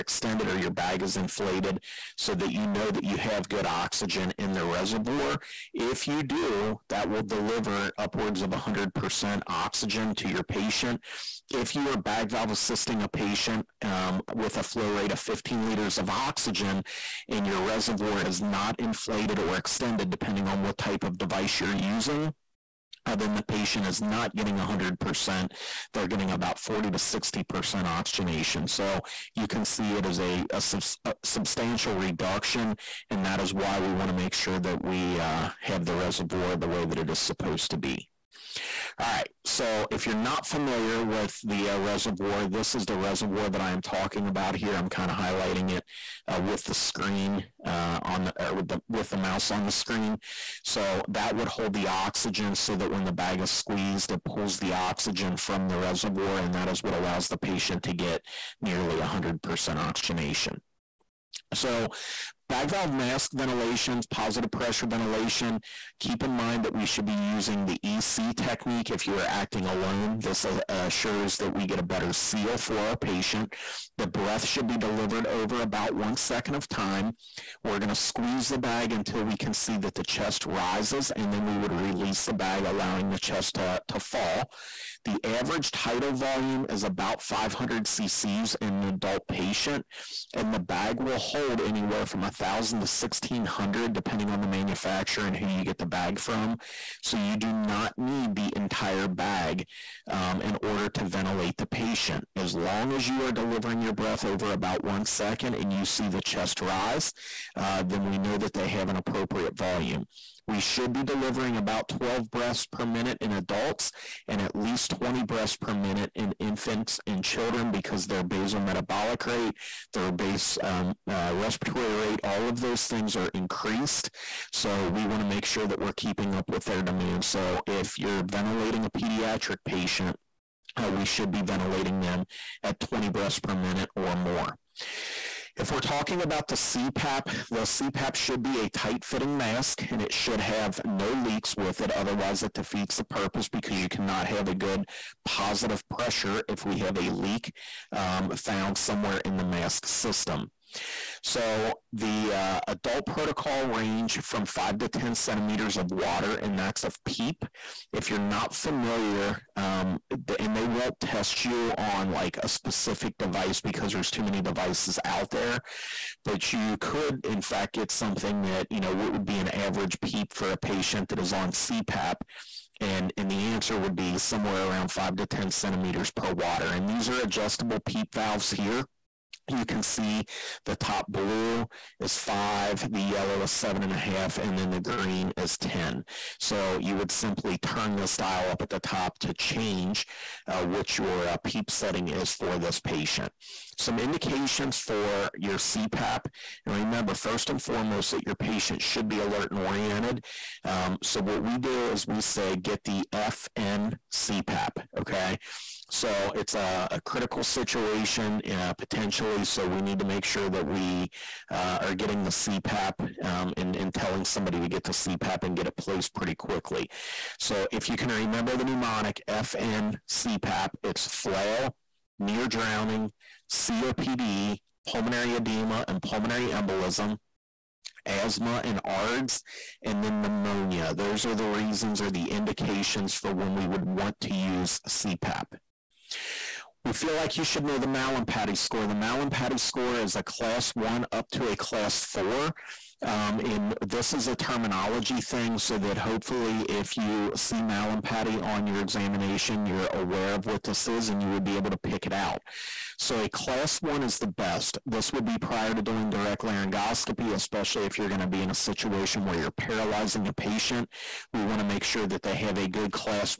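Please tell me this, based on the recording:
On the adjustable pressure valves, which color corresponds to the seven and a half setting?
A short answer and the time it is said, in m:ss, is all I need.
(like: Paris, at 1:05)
Yellow, at 3:03.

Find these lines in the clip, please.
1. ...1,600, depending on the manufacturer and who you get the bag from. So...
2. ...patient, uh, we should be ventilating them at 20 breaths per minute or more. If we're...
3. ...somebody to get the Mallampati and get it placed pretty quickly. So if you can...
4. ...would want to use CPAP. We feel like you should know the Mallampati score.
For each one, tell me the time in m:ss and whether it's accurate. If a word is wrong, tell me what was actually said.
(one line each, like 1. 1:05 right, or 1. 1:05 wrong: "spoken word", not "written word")
1. 1:32 right
2. 2:09 right
3. 3:34 wrong: "CPAP", not "Mallampati"
4. 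3:53 right.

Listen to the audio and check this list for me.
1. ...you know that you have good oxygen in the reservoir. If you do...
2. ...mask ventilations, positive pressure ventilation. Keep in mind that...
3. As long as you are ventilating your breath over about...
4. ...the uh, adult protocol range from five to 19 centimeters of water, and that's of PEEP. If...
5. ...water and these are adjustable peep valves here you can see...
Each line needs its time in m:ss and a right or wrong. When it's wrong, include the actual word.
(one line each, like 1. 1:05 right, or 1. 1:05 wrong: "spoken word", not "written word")
1. 0:02 right
2. 1:02 right
3. 1:42 wrong: "delivering", not "ventilating"
4. 2:31 wrong: "10", not "19"
5. 2:56 right.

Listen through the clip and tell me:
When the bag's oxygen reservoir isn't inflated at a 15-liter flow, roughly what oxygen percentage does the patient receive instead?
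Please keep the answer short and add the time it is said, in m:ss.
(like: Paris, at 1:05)
40 to 60%, at 0:26.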